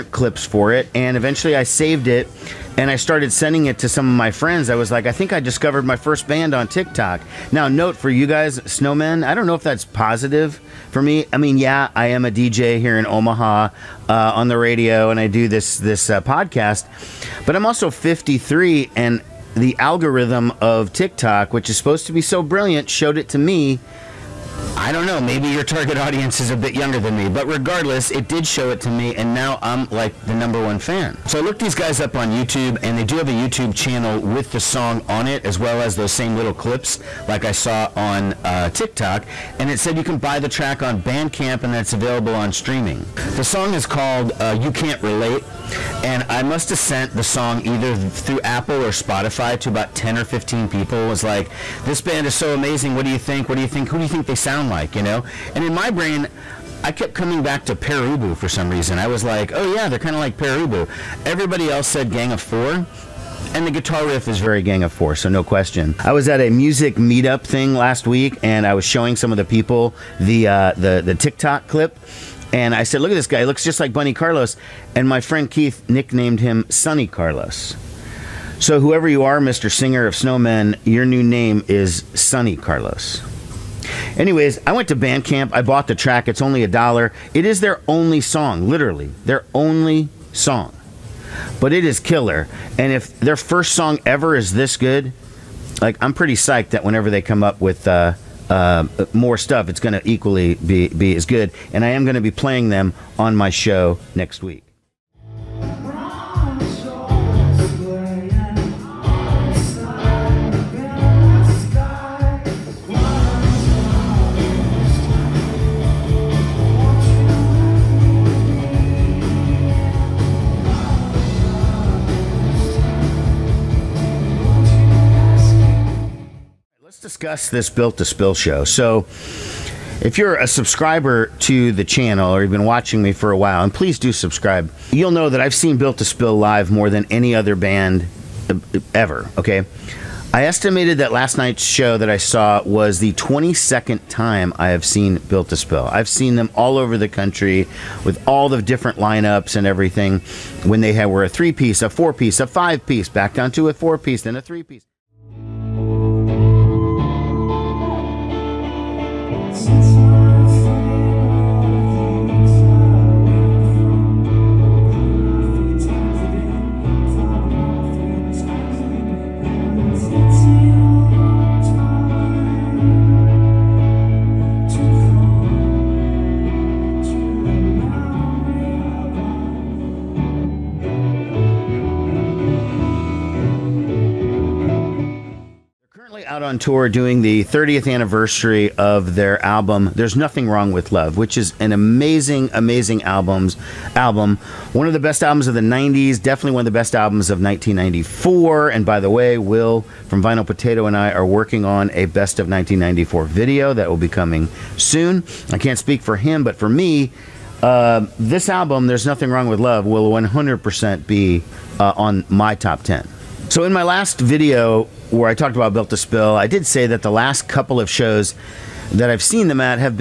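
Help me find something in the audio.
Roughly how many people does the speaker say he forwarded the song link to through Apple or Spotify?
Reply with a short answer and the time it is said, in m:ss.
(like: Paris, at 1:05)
10 or 15, at 0:49.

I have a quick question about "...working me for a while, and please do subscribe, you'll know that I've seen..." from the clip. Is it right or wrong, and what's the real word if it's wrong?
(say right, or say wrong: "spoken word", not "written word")
wrong: "watching", not "working".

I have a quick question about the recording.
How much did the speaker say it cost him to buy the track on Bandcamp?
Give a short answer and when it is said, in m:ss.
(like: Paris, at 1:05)
A dollar, at 1:26.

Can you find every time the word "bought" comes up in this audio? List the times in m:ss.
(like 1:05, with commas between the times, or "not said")
1:25.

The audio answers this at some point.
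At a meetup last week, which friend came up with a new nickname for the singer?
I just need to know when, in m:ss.
1:15.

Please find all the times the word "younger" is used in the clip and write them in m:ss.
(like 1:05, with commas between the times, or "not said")
0:26.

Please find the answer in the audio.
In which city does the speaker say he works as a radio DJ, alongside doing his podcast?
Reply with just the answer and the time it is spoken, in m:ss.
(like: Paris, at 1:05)
Omaha, at 0:13.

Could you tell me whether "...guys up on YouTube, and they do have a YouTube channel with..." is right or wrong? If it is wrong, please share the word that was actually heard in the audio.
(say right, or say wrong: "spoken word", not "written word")
right.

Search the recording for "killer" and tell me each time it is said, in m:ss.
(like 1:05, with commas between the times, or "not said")
1:31.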